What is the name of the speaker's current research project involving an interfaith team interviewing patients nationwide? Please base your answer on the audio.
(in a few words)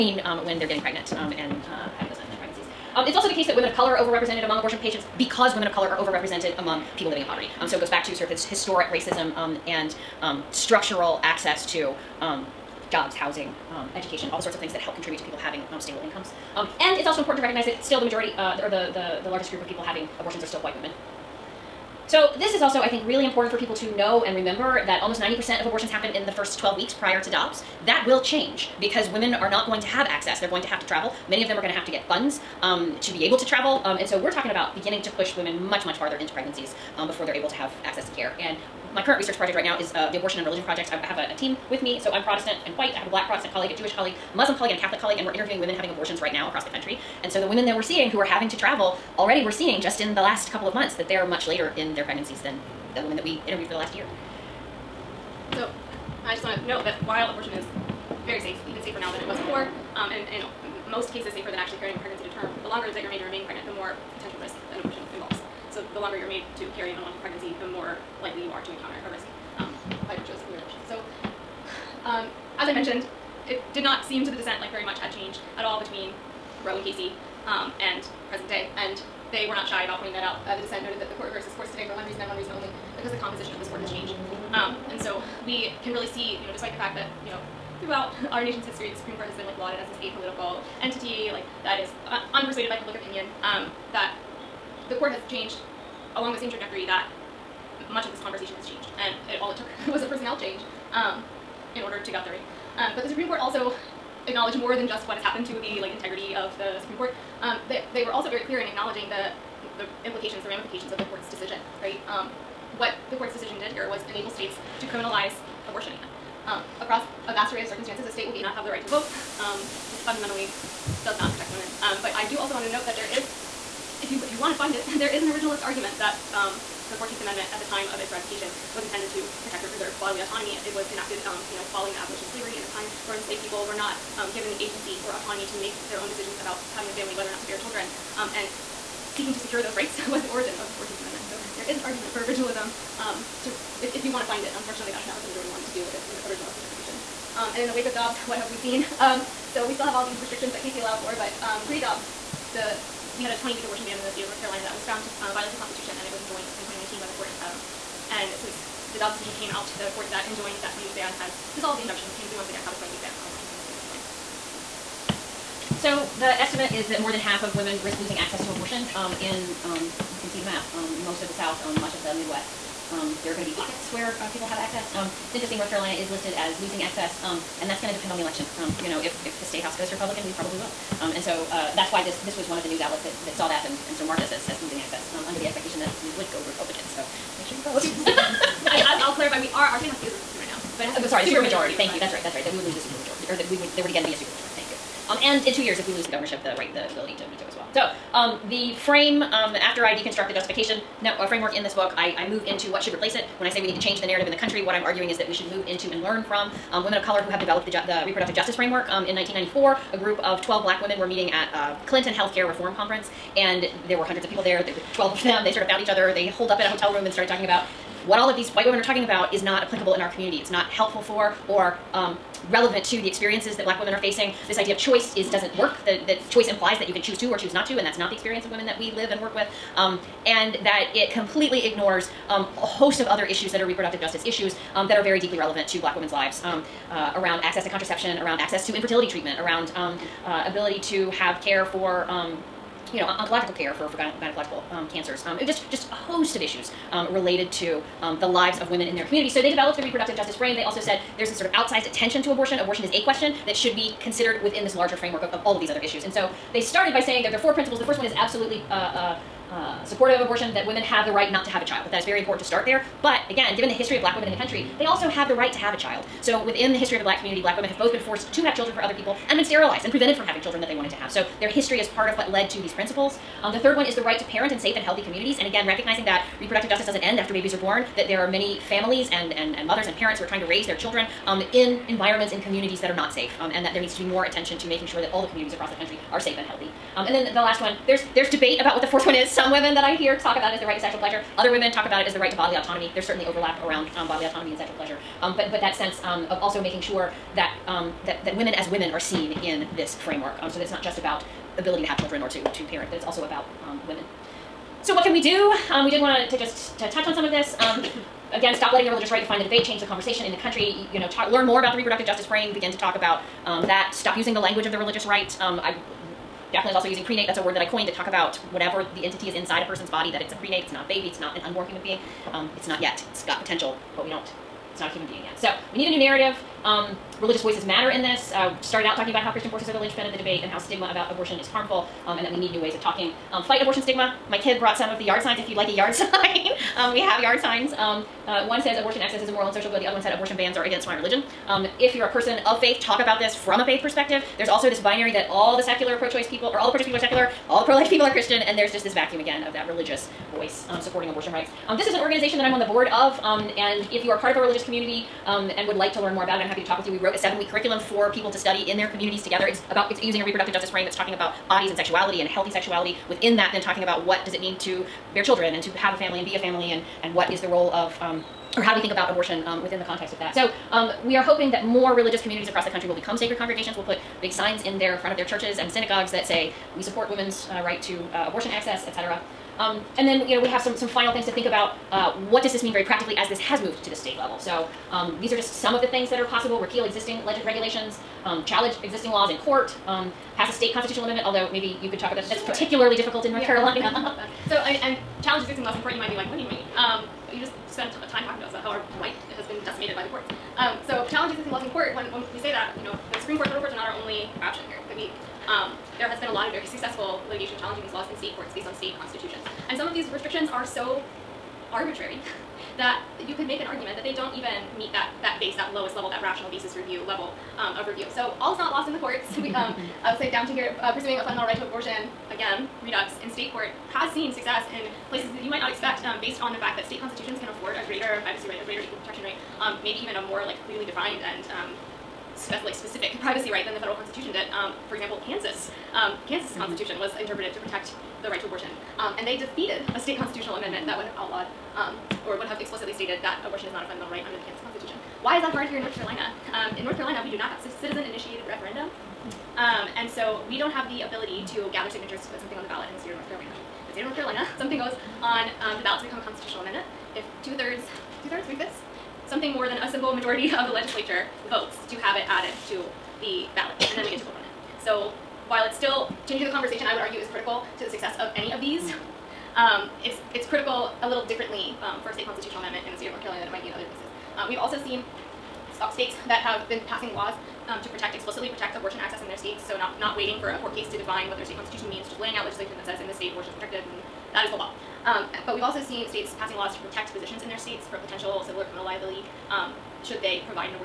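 Abortion and Religion Project.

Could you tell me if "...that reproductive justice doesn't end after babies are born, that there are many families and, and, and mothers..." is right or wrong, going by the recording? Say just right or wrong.
right.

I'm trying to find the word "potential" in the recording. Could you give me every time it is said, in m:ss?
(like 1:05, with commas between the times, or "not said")
1:04, 5:23, 8:08.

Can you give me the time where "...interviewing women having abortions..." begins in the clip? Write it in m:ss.
0:45.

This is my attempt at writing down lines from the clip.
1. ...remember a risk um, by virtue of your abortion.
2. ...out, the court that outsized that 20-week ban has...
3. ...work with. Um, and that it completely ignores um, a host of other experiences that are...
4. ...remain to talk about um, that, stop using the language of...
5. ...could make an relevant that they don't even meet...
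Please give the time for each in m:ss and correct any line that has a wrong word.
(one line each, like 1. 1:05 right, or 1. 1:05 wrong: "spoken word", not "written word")
1. 1:08 wrong: "encounter", not "remember"
2. 2:39 wrong: "enjoined", not "outsized"
3. 3:49 wrong: "issues", not "experiences"
4. 5:12 wrong: "begin", not "remain"
5. 6:53 wrong: "argument", not "relevant".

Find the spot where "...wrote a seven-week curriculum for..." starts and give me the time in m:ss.
5:56.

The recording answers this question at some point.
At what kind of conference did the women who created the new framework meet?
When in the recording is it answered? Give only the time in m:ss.
3:31.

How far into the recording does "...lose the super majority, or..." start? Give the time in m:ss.
3:12.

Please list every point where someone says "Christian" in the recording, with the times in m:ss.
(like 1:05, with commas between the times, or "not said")
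5:29, 5:48.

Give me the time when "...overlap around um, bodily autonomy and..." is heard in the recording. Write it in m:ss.
4:53.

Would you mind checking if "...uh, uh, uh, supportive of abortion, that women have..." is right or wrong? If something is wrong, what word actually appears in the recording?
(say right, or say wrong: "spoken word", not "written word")
right.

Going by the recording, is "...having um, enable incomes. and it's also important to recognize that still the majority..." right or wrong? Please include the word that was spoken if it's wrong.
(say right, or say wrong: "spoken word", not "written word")
wrong: "stable", not "enable".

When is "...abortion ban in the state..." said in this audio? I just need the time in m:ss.
2:33.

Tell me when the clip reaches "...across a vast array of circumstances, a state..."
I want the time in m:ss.
1:56.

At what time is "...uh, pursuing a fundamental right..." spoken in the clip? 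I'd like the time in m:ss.
7:00.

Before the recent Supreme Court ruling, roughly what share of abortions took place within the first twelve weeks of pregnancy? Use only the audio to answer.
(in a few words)
almost 90%.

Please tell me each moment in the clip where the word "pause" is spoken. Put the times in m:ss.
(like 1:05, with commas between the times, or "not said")
not said.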